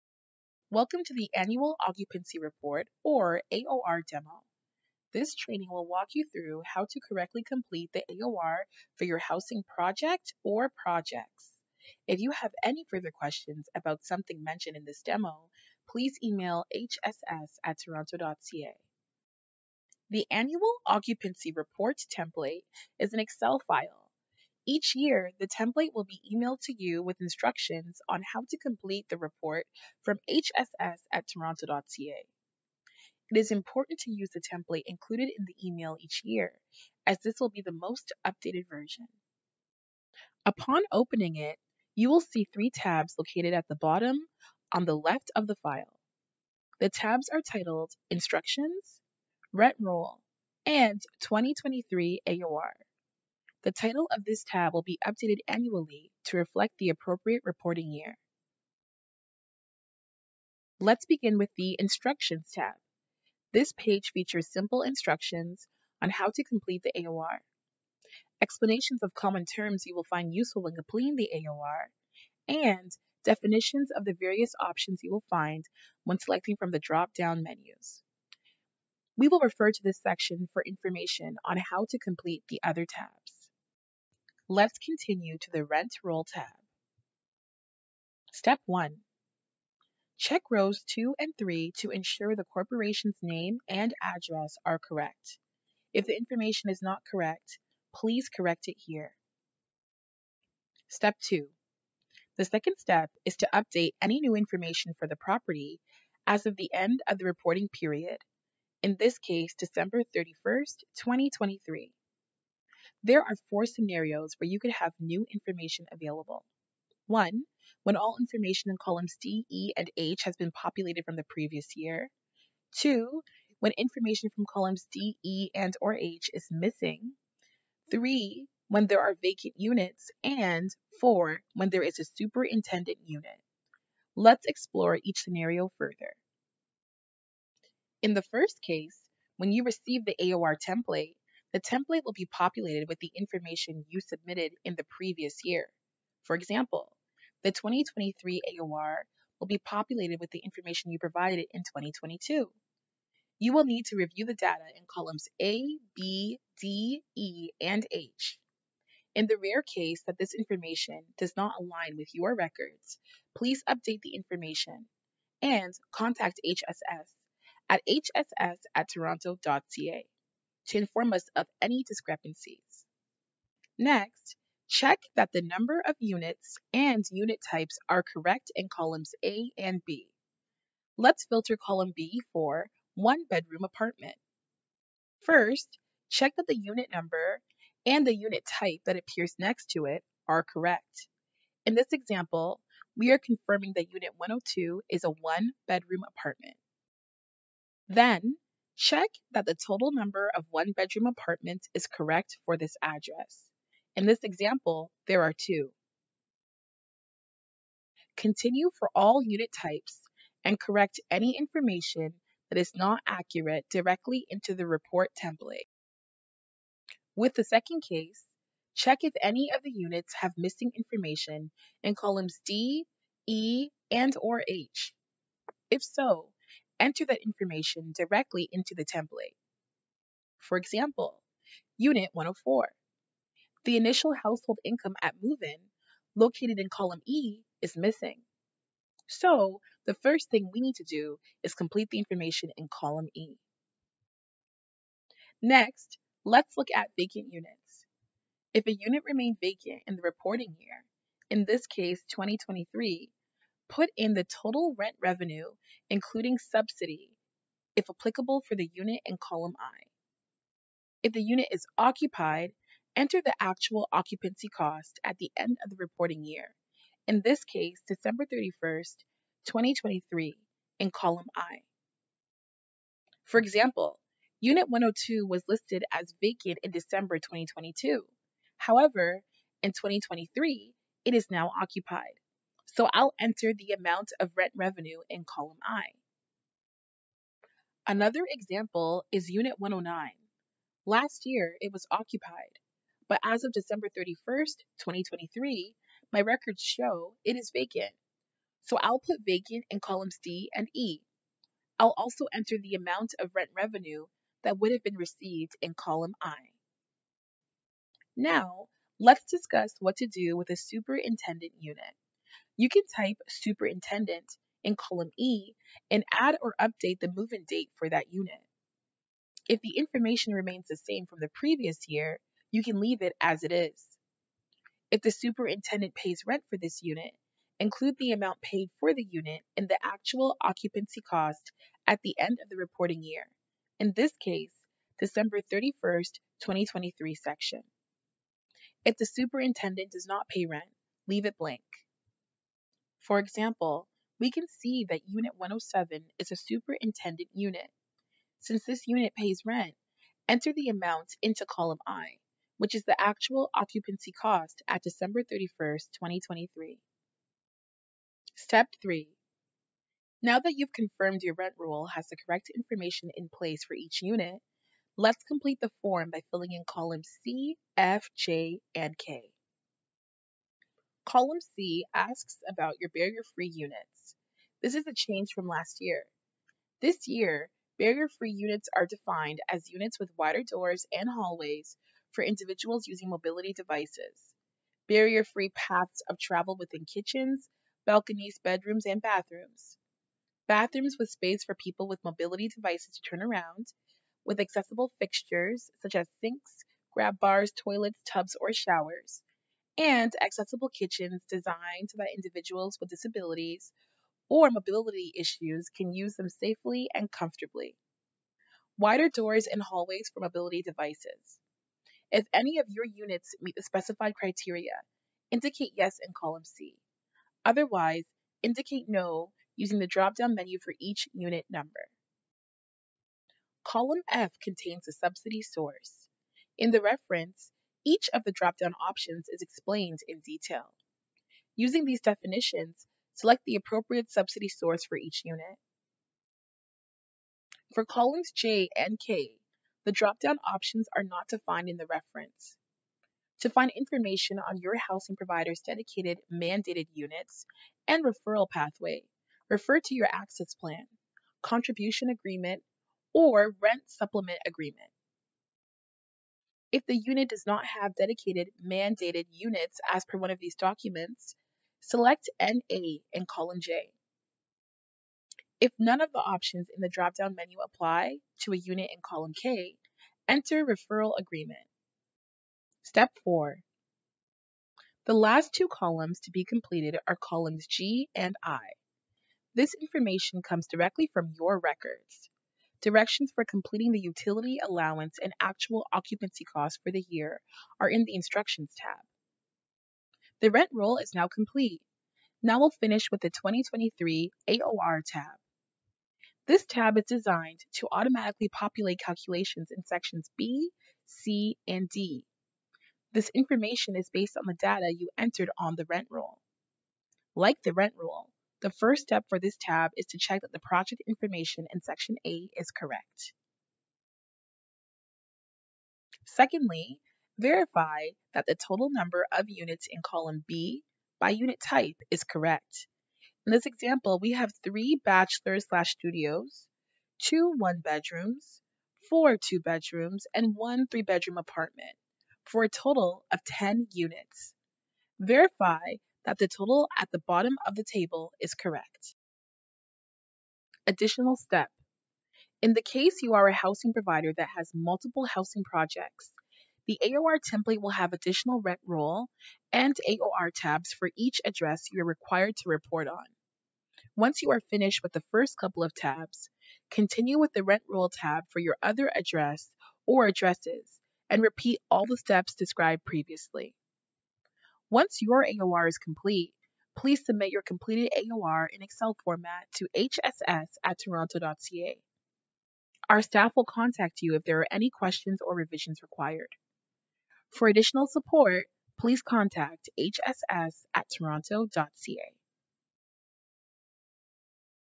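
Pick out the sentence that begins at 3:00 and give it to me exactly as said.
Let's filter column B for one-bedroom apartment.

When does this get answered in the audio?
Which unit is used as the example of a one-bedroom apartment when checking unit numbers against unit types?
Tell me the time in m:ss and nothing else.
3:13.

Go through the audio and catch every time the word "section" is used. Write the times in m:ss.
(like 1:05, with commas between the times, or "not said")
1:20, 5:37, 8:19, 8:31.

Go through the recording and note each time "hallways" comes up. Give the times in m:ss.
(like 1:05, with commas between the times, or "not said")
6:21, 6:49.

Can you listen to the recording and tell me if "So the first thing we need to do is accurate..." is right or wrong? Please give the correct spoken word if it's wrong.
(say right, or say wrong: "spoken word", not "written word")
wrong: "complete", not "accurate".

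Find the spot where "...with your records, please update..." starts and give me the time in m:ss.
2:41.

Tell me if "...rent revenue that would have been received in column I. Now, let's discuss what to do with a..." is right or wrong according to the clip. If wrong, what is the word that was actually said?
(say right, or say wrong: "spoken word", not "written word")
right.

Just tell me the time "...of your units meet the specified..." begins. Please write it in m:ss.
6:52.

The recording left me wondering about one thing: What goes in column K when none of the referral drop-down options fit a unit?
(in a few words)
referral agreement.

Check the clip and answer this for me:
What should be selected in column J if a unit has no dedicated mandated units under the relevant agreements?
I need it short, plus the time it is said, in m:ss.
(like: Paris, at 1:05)
NA, at 7:42.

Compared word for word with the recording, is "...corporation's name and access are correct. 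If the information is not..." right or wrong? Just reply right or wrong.
wrong.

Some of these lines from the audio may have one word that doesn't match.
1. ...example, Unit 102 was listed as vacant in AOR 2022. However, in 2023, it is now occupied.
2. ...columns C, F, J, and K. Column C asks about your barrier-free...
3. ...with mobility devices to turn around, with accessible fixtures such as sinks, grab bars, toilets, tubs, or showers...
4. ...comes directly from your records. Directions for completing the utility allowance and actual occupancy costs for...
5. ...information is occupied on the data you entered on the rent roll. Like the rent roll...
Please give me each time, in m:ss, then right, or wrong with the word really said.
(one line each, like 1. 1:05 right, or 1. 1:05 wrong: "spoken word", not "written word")
1. 4:33 wrong: "December", not "AOR"
2. 6:06 right
3. 6:31 right
4. 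8:00 right
5. 8:23 wrong: "based", not "occupied".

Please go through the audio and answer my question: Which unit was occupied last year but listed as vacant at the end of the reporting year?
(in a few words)
Unit 109.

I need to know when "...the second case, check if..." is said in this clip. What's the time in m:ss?
3:37.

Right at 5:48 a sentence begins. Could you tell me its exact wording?
Since this unit pays rent, enter the amount into column I, which is the actual occupancy cost at December 31st, 2023.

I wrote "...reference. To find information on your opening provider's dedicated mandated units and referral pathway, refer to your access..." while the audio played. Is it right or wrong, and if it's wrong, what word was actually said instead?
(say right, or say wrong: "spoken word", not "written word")
wrong: "housing", not "opening".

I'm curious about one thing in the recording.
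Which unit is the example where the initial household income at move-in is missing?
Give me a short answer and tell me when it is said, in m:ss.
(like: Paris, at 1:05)
Unit 104, at 3:51.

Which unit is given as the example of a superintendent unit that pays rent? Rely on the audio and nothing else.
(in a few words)
Unit 107.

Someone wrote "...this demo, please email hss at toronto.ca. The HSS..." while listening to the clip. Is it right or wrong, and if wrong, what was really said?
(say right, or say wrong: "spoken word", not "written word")
wrong: "Annual", not "HSS".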